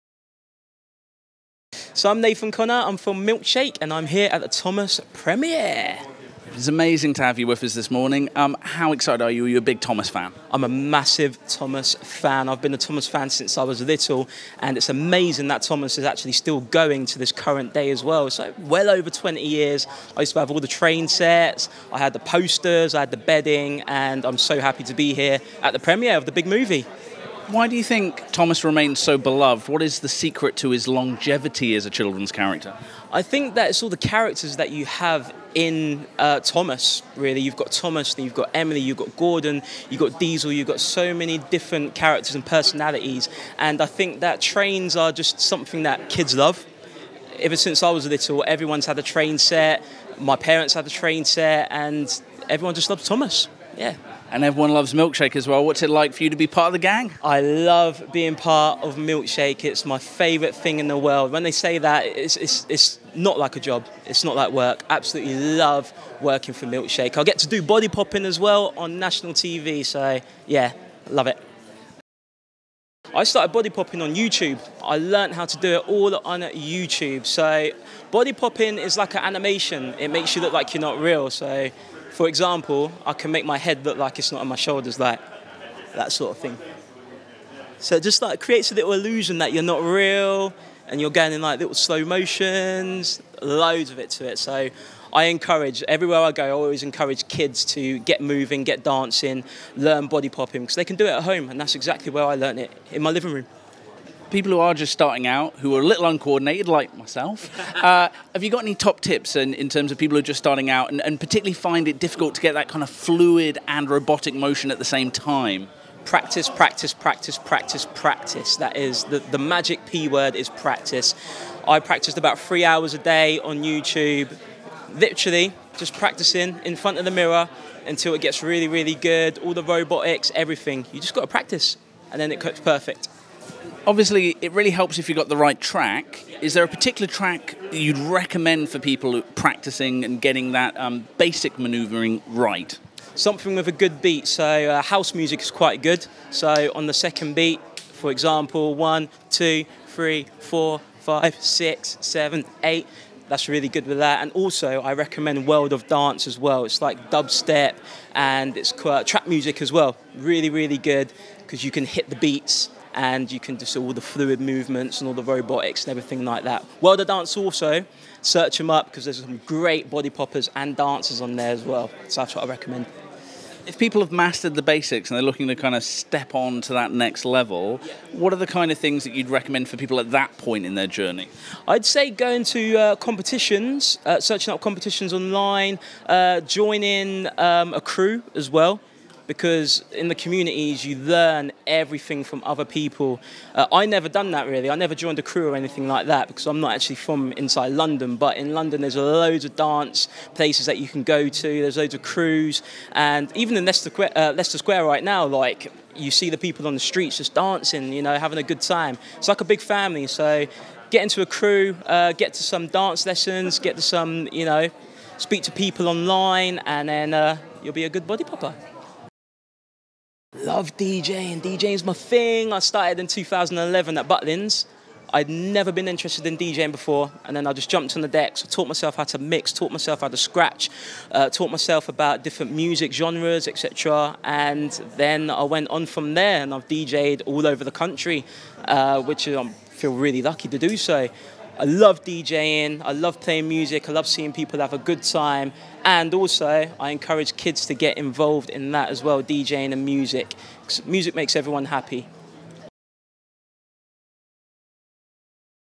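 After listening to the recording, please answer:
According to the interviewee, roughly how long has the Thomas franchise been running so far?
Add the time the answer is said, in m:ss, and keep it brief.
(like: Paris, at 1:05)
Over 20 years, at 0:18.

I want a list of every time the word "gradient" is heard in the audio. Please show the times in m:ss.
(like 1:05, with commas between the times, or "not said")
not said.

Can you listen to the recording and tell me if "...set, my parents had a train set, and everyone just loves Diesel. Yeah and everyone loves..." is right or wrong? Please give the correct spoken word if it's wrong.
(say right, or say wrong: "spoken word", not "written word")
wrong: "Thomas", not "Diesel".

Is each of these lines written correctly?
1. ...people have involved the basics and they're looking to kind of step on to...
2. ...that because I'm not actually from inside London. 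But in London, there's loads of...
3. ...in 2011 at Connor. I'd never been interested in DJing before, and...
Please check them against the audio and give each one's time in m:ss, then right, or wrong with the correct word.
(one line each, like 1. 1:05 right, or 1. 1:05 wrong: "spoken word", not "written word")
1. 2:53 wrong: "mastered", not "involved"
2. 3:16 right
3. 3:43 wrong: "Butlins", not "Connor".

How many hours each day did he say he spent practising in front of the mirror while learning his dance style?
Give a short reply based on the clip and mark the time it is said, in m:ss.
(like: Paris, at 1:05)
3 hours, at 2:02.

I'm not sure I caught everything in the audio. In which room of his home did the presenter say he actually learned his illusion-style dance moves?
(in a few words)
Living room.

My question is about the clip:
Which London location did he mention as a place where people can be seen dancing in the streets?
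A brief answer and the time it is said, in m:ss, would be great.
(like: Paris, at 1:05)
Leicester Square, at 3:24.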